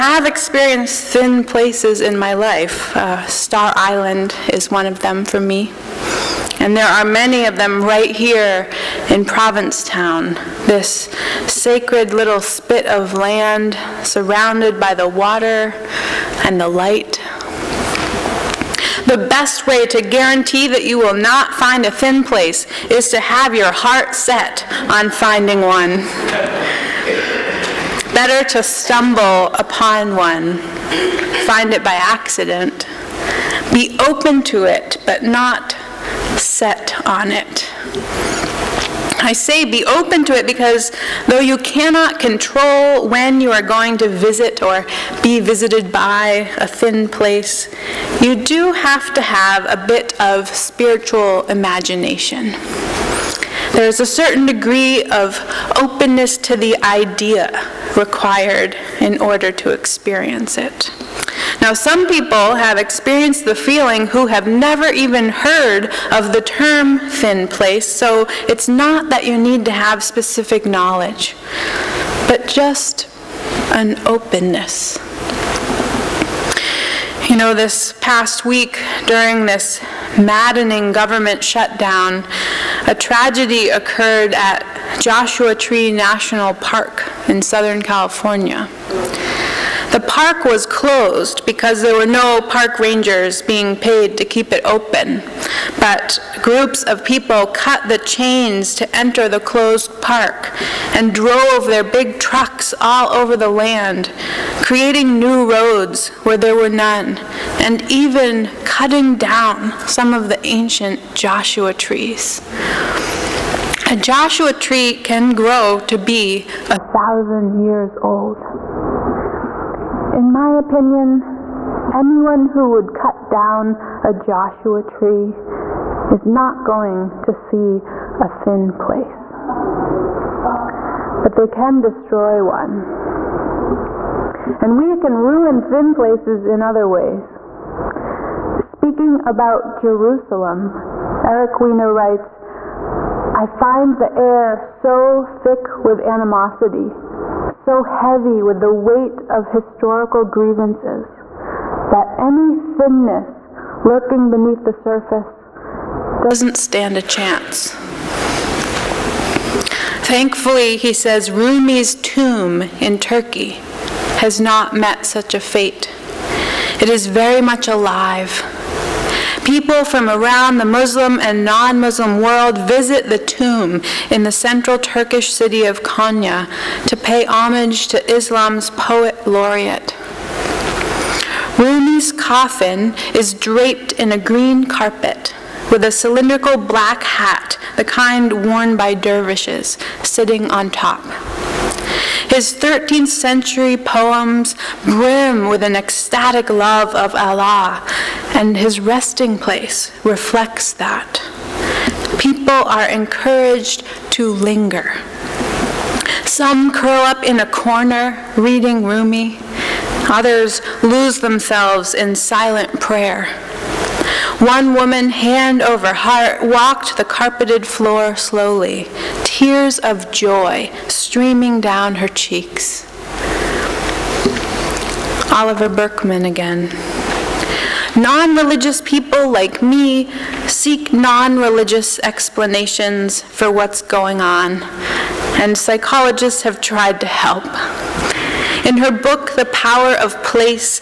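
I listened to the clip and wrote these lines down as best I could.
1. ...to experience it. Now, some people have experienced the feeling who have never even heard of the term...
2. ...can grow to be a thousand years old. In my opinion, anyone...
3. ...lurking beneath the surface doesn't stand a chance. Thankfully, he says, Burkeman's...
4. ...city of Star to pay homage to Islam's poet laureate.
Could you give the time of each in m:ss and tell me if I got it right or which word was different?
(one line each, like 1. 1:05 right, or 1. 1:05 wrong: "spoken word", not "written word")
1. 0:59 right
2. 1:55 right
3. 2:33 wrong: "Rumi", not "Burkeman"
4. 2:55 wrong: "Konya", not "Star".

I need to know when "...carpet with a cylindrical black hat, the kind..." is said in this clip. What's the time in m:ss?
3:04.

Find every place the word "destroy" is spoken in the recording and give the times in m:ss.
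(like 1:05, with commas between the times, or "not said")
2:11.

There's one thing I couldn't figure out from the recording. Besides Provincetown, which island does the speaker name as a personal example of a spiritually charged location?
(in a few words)
Star Island.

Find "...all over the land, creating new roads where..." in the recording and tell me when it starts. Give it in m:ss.
1:42.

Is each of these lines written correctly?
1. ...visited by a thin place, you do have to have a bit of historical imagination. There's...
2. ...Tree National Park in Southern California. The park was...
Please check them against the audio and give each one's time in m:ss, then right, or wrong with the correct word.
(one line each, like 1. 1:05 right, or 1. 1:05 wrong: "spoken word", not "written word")
1. 0:45 wrong: "spiritual", not "historical"
2. 1:25 right.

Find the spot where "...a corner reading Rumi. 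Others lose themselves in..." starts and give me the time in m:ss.
3:27.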